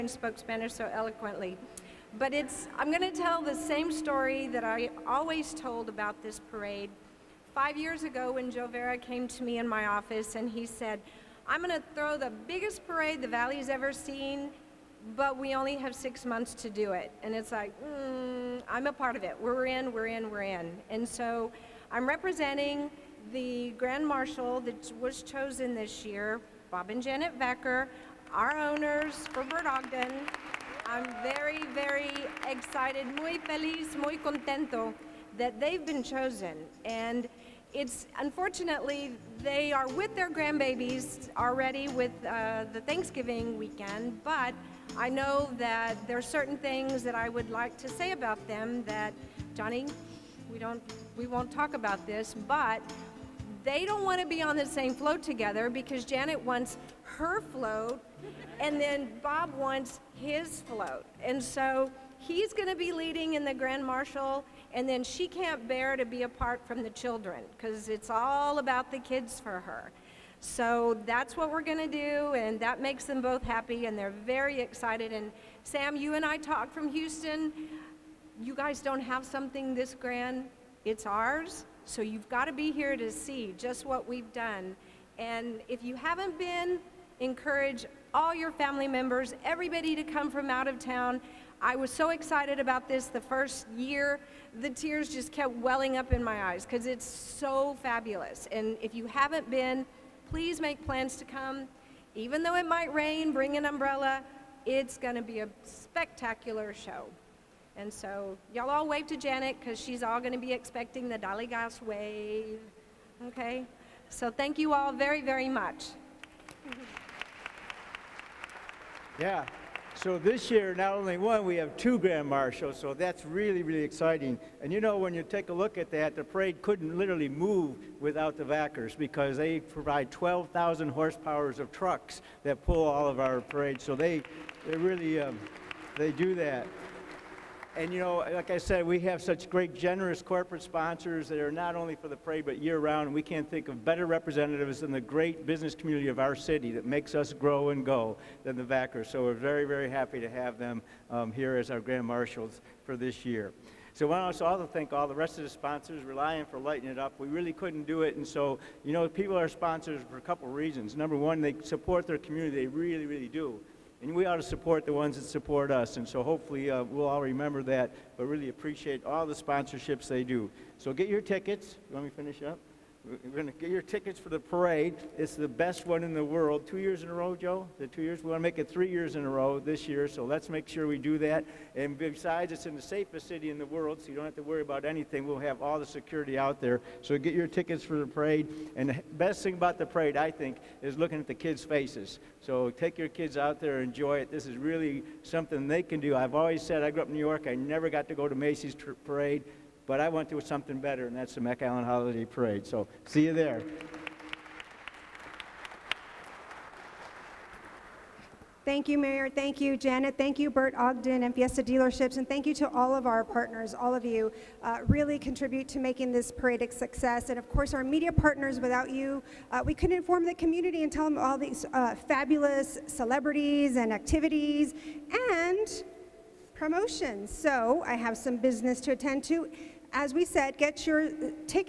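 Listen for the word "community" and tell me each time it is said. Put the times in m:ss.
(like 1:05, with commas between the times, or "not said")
2:25, 2:42, 3:40.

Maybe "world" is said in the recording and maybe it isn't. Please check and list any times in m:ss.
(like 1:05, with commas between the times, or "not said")
2:56, 3:03.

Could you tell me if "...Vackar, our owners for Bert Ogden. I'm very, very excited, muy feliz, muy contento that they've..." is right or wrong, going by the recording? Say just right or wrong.
right.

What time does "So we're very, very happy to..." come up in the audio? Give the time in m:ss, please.
2:29.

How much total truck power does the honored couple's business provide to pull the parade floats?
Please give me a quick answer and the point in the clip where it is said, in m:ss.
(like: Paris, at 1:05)
12,000 horsepower, at 2:10.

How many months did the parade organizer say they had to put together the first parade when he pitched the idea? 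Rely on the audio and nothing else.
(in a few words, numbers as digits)
6.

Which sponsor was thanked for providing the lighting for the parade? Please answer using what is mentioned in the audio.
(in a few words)
Reliant.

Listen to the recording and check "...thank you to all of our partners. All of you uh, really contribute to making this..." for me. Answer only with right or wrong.
right.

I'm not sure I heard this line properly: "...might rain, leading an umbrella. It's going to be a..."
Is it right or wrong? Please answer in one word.
wrong.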